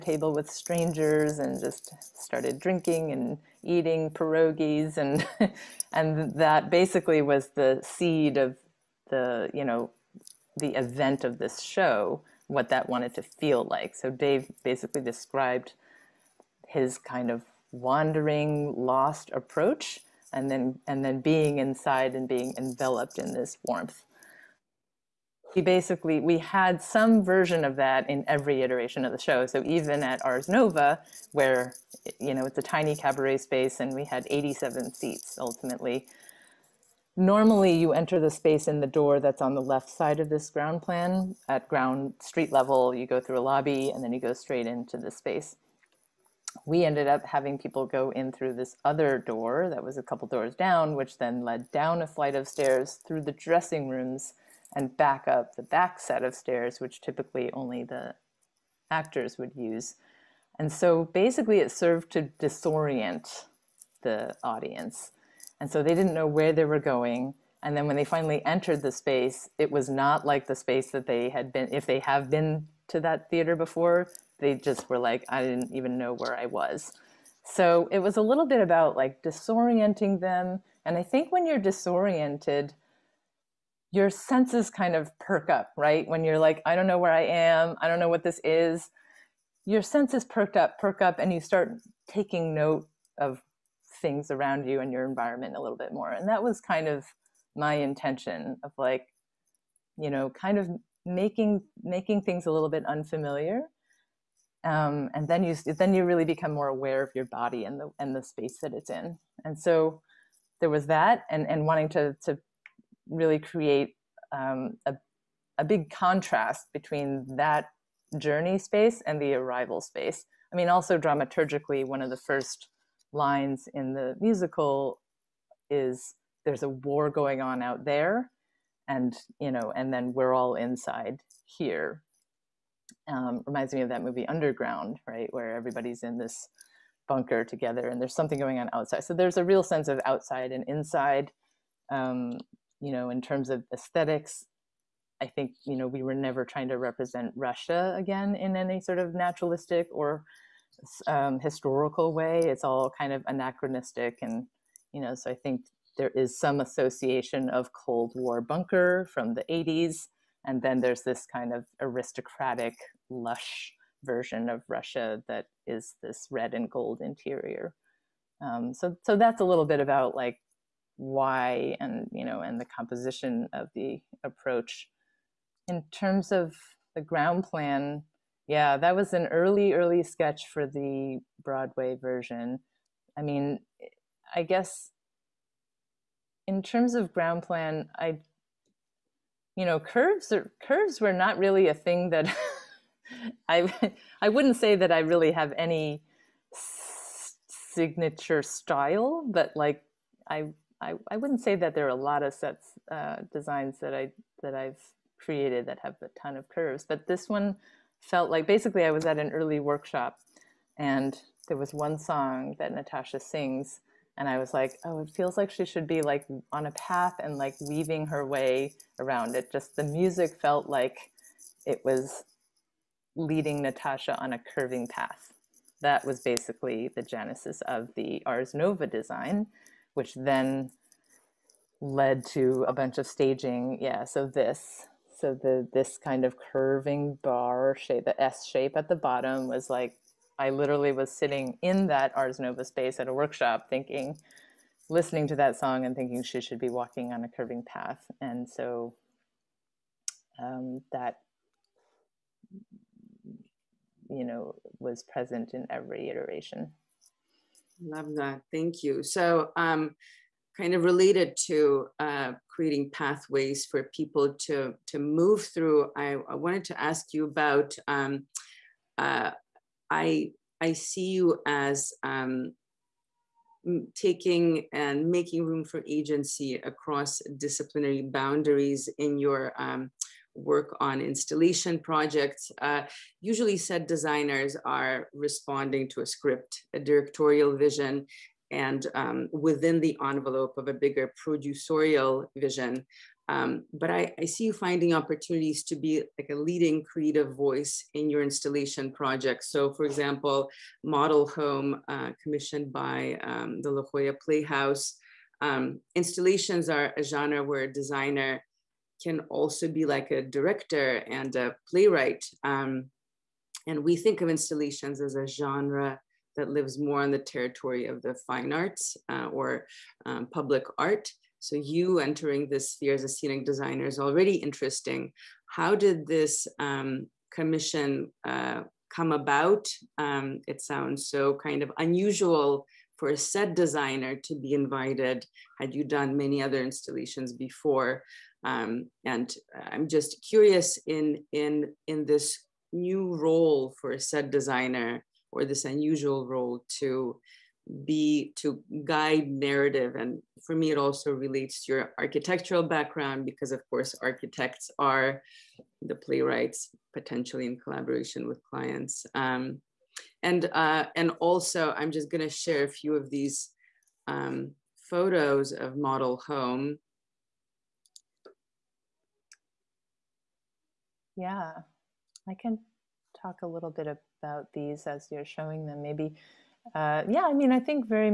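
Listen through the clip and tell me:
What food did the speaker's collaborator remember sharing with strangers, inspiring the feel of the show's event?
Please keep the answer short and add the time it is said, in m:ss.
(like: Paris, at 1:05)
Pierogies, at 0:04.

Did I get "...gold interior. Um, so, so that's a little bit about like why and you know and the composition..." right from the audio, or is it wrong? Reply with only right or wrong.
right.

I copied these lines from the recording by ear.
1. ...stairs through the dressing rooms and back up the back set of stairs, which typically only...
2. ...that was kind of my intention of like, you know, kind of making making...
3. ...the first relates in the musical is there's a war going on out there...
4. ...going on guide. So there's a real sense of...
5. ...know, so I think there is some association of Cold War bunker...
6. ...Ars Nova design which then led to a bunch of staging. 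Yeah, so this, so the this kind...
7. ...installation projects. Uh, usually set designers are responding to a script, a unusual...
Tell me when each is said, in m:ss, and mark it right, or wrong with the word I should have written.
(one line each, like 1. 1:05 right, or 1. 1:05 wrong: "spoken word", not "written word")
1. 0:52 right
2. 1:36 right
3. 2:02 wrong: "lines", not "relates"
4. 2:18 wrong: "outside", not "guide"
5. 2:35 right
6. 3:48 right
7. 4:40 wrong: "directorial", not "unusual".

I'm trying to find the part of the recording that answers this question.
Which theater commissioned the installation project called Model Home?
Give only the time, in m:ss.
5:03.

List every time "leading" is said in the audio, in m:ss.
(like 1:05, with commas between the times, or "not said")
3:43, 4:56.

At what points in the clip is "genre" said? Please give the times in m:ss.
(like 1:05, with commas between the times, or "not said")
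5:07, 5:15.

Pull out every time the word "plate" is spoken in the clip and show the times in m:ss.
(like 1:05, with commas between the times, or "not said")
not said.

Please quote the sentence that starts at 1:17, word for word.
So it was a little bit about like disorienting them.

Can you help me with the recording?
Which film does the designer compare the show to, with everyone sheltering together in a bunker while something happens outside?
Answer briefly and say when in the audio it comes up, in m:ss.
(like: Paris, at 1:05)
Underground, at 2:14.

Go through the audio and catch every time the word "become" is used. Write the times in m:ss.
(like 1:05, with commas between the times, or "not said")
1:46.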